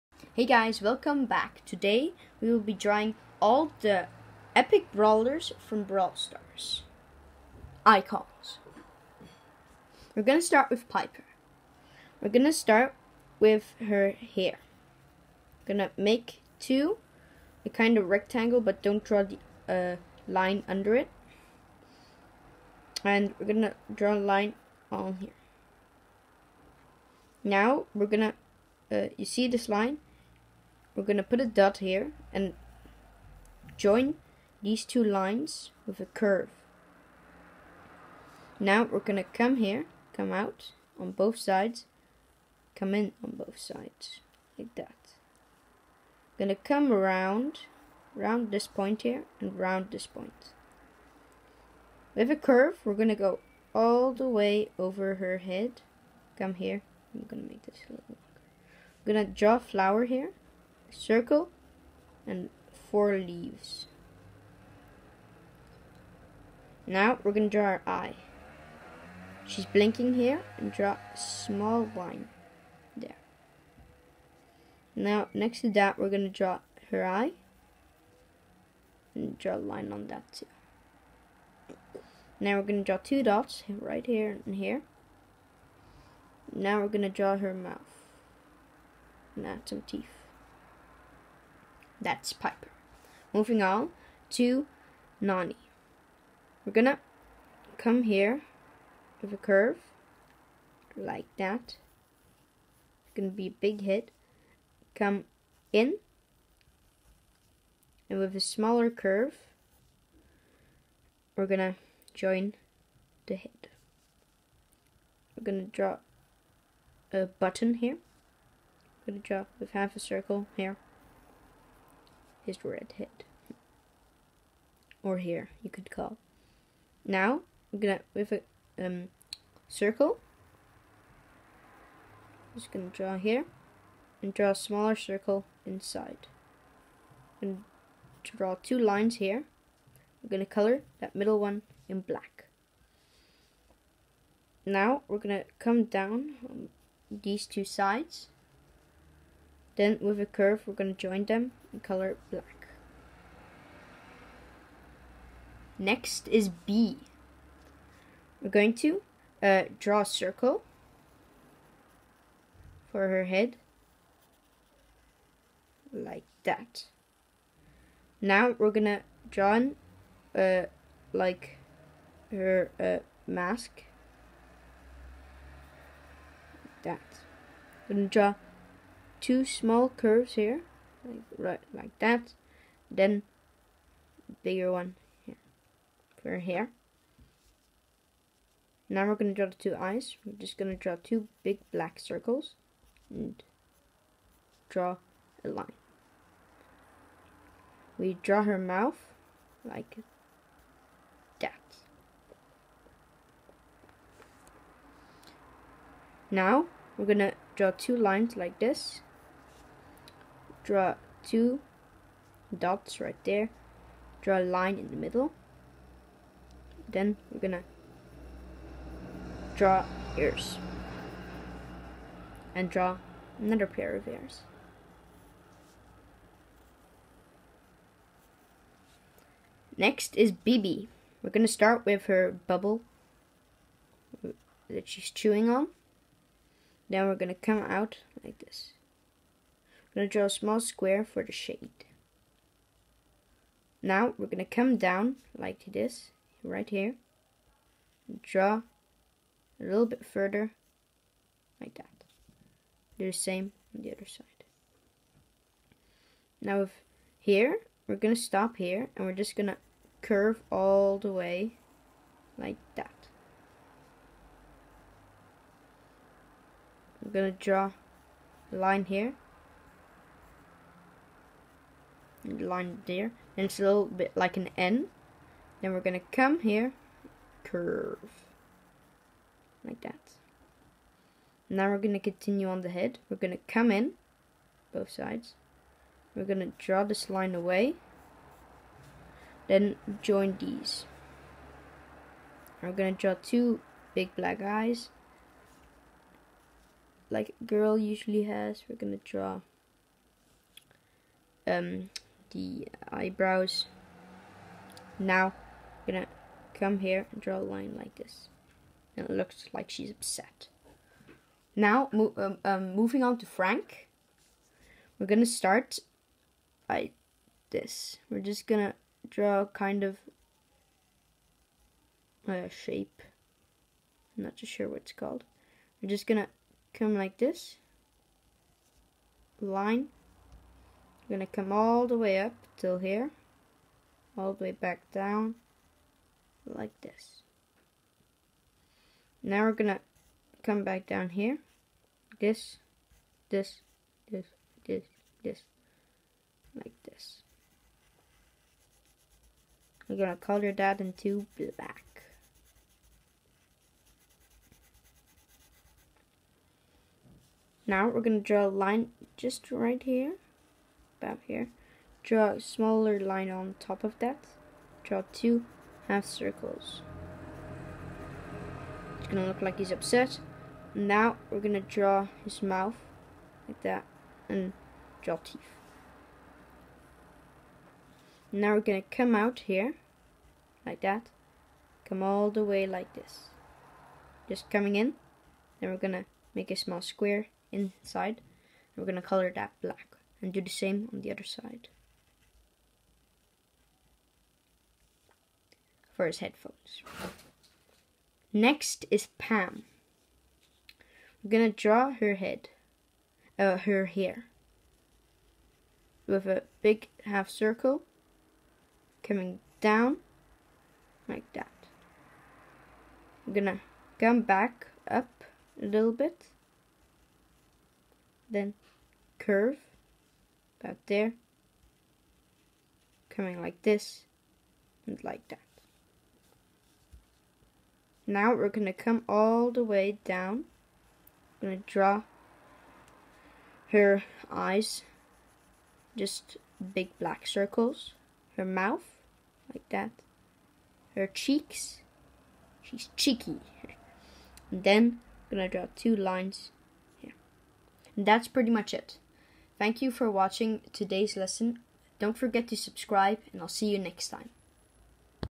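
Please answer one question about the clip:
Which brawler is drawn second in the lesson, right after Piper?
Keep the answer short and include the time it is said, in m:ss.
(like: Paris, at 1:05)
Nani, at 1:35.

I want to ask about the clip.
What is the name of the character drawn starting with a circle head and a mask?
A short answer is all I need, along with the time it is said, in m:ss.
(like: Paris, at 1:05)
Bea, at 2:36.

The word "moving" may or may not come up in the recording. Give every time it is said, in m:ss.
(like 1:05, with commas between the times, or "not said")
1:33, 5:12.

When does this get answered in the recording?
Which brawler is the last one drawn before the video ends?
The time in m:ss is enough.
6:39.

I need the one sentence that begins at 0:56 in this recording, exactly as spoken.
Come here, I'm gonna make this a little longer.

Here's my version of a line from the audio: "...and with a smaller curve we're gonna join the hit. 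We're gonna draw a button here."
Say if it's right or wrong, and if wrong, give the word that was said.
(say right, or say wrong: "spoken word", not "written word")
right.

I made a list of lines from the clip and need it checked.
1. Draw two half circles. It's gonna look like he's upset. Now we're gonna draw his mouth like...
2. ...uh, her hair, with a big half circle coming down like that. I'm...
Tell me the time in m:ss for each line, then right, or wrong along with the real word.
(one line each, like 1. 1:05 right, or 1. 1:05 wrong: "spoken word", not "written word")
1. 6:04 right
2. 6:43 right.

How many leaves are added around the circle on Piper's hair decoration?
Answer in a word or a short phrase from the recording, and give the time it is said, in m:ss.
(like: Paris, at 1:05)
4, at 1:02.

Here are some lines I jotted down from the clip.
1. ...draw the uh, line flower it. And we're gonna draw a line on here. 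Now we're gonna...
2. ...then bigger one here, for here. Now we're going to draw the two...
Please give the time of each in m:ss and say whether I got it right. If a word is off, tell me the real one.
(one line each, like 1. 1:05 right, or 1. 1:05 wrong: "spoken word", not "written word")
1. 0:19 wrong: "under", not "flower"
2. 3:02 right.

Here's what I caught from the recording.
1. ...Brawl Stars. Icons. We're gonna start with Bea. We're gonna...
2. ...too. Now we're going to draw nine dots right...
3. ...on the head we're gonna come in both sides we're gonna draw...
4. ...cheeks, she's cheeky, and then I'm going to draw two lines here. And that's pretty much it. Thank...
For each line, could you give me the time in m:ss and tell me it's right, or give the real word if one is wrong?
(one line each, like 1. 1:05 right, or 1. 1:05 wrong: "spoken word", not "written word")
1. 0:05 wrong: "Piper", not "Bea"
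2. 1:20 wrong: "two", not "nine"
3. 4:42 right
4. 7:21 right.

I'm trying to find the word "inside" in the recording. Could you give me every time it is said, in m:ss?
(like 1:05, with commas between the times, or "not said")
2:15, 6:27.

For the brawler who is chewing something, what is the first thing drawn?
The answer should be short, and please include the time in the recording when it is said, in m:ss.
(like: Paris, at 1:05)
her bubble, at 3:52.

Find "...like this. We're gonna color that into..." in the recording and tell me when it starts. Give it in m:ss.
5:46.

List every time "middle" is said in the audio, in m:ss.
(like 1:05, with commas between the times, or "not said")
2:21, 3:34.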